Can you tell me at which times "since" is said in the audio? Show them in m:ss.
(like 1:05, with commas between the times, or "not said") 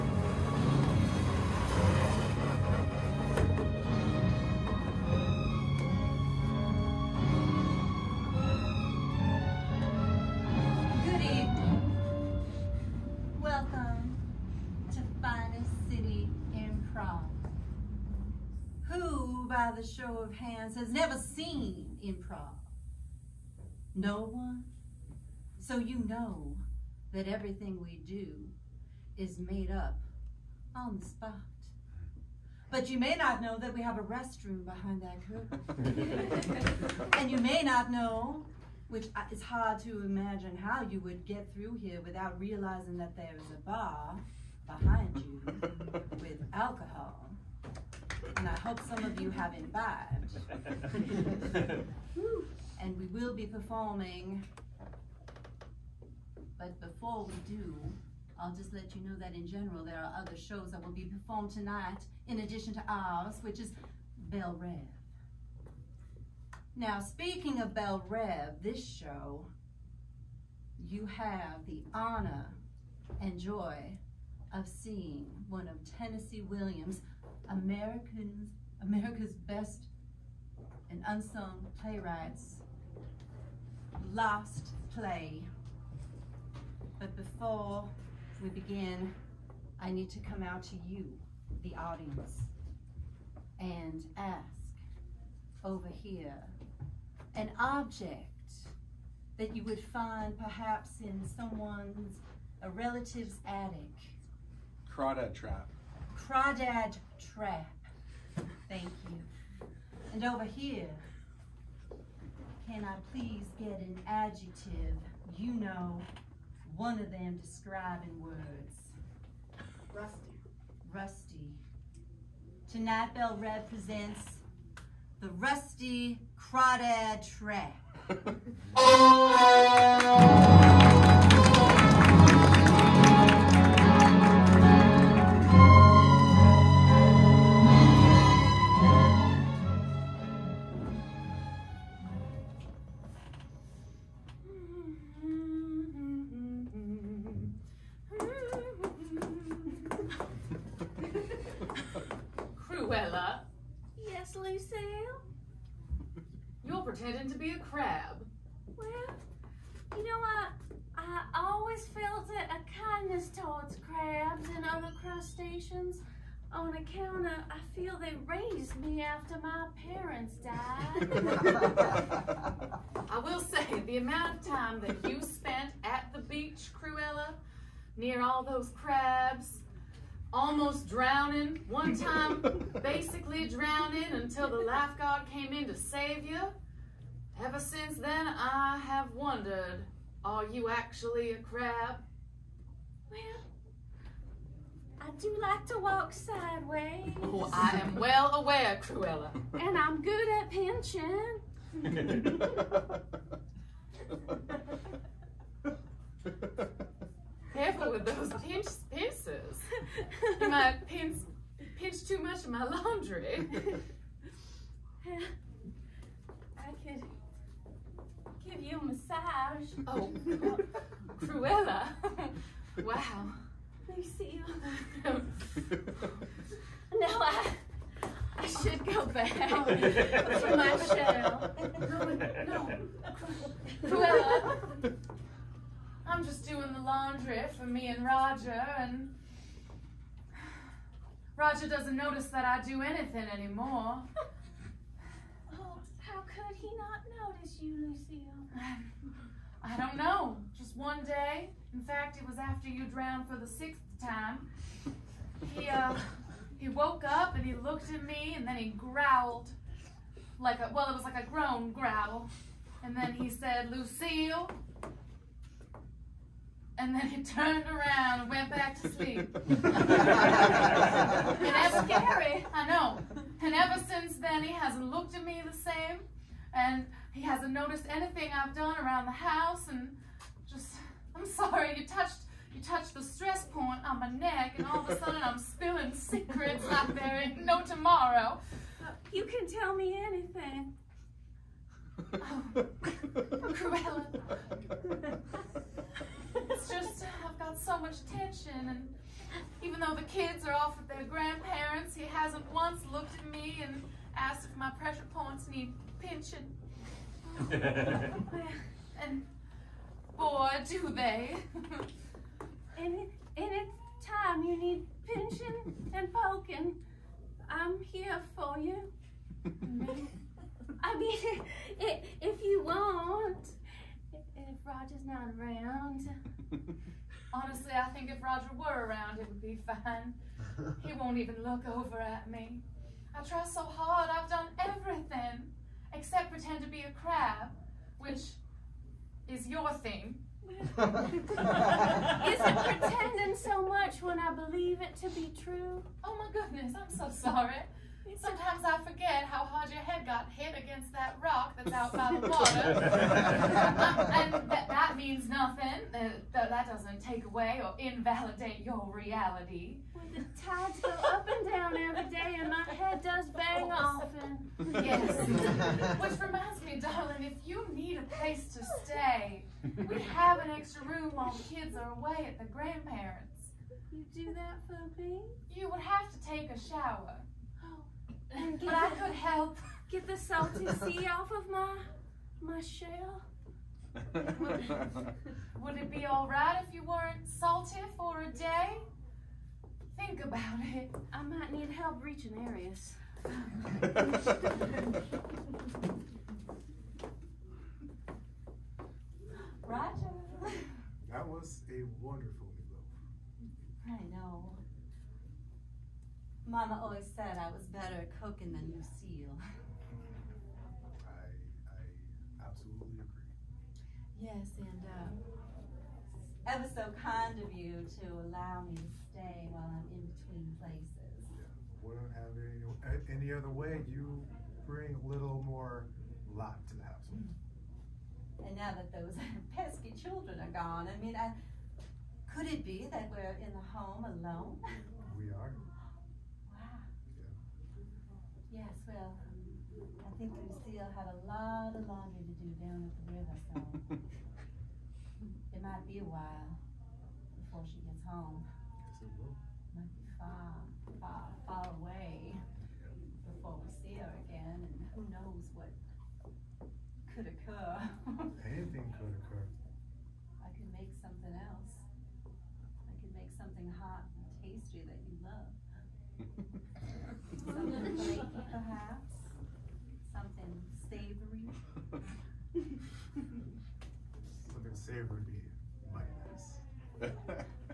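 3:07, 4:33.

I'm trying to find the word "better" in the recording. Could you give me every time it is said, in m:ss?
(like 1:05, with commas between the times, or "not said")
6:47.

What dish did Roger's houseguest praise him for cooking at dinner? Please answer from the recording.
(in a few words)
Meatloaf.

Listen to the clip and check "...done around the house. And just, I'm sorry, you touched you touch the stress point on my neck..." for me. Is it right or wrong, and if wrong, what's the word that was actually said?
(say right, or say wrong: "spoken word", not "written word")
right.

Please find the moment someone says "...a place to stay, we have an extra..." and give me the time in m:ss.
6:07.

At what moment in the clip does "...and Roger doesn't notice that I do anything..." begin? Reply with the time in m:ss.
3:58.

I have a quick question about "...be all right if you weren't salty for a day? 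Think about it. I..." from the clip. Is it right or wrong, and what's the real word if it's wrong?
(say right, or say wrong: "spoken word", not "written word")
right.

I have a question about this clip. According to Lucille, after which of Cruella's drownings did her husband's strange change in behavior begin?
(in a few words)
sixth.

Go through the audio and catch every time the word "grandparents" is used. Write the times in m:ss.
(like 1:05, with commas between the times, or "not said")
5:01, 6:12.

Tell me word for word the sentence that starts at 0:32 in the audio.
But you may not know that we have a restroom behind that curtain.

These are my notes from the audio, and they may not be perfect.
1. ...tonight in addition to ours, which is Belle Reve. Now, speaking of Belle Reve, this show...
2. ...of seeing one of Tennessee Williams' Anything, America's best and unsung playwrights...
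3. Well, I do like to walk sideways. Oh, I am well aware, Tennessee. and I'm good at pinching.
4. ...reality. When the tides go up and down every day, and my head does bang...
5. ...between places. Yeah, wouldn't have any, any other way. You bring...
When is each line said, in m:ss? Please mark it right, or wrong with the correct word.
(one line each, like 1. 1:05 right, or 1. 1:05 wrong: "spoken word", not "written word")
1. 1:01 right
2. 1:14 wrong: "Americans", not "Anything"
3. 3:13 wrong: "Cruella", not "Tennessee"
4. 5:58 right
5. 7:00 right.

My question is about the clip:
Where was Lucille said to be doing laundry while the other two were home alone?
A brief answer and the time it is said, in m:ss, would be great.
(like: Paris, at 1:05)
the river, at 7:23.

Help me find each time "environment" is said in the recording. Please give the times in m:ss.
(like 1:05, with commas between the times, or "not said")
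not said.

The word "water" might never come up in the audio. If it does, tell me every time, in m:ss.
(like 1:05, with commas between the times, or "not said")
5:52.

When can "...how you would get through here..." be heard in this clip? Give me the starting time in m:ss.
0:40.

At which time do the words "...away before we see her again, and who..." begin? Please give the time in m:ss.
7:31.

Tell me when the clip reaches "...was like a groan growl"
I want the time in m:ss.
4:20.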